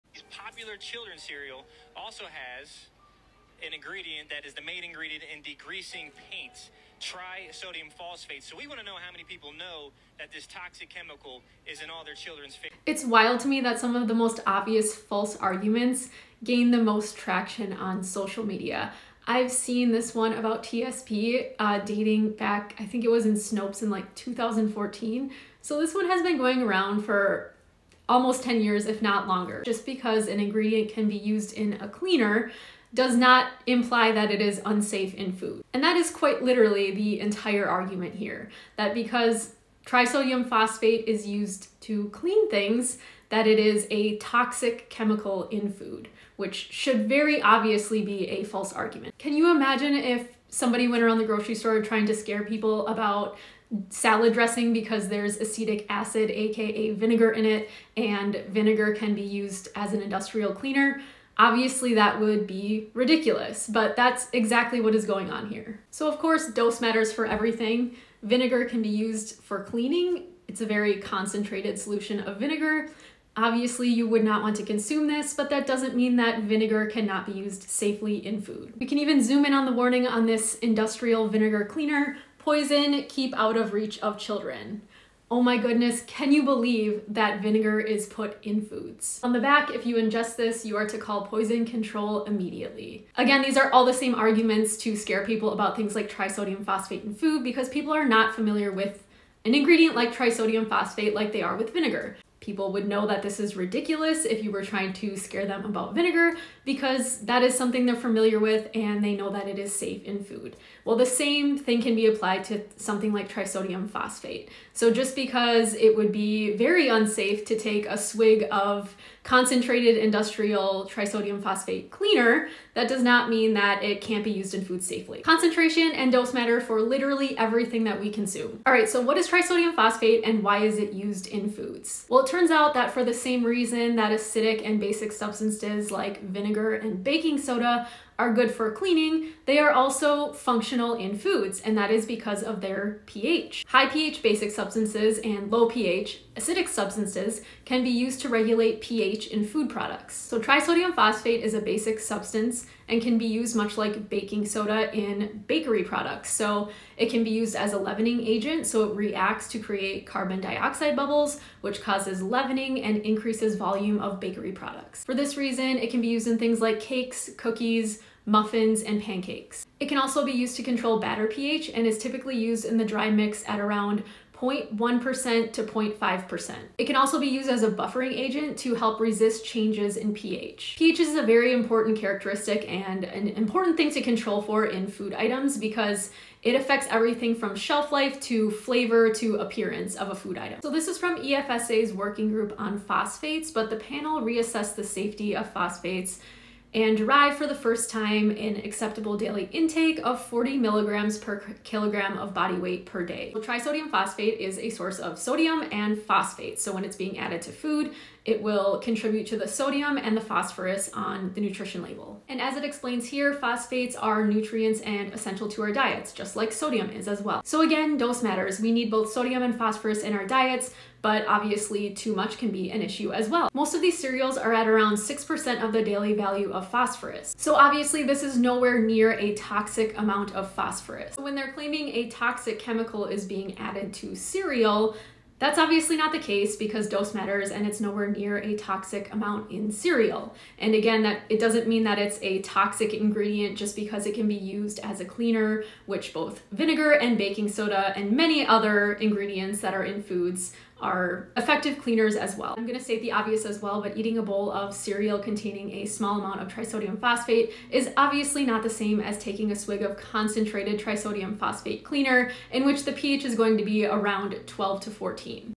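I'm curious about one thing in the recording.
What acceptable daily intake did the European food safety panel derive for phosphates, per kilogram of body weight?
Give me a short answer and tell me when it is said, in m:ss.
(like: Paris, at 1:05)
40 milligrams, at 3:20.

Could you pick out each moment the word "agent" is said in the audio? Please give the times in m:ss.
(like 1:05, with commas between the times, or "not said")
2:38, 2:58.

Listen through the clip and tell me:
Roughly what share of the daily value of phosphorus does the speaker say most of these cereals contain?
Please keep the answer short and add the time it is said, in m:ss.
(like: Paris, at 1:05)
6%, at 3:44.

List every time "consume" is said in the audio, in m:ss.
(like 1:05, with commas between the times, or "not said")
1:14, 2:08.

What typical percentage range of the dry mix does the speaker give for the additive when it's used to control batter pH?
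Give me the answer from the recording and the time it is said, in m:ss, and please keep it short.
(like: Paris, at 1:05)
0.1% to 0.5%, at 2:54.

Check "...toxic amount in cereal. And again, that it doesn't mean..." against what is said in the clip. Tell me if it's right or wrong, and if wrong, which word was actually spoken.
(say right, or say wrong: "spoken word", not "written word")
right.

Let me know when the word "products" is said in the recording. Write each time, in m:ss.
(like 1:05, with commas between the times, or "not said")
2:29, 2:35, 2:44.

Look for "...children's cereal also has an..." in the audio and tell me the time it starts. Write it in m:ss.
0:00.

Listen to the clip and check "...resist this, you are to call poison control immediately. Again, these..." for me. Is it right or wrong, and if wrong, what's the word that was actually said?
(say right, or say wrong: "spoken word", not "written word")
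wrong: "ingest", not "resist".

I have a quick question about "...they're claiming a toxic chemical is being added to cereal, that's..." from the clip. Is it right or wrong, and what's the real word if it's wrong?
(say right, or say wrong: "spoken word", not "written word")
right.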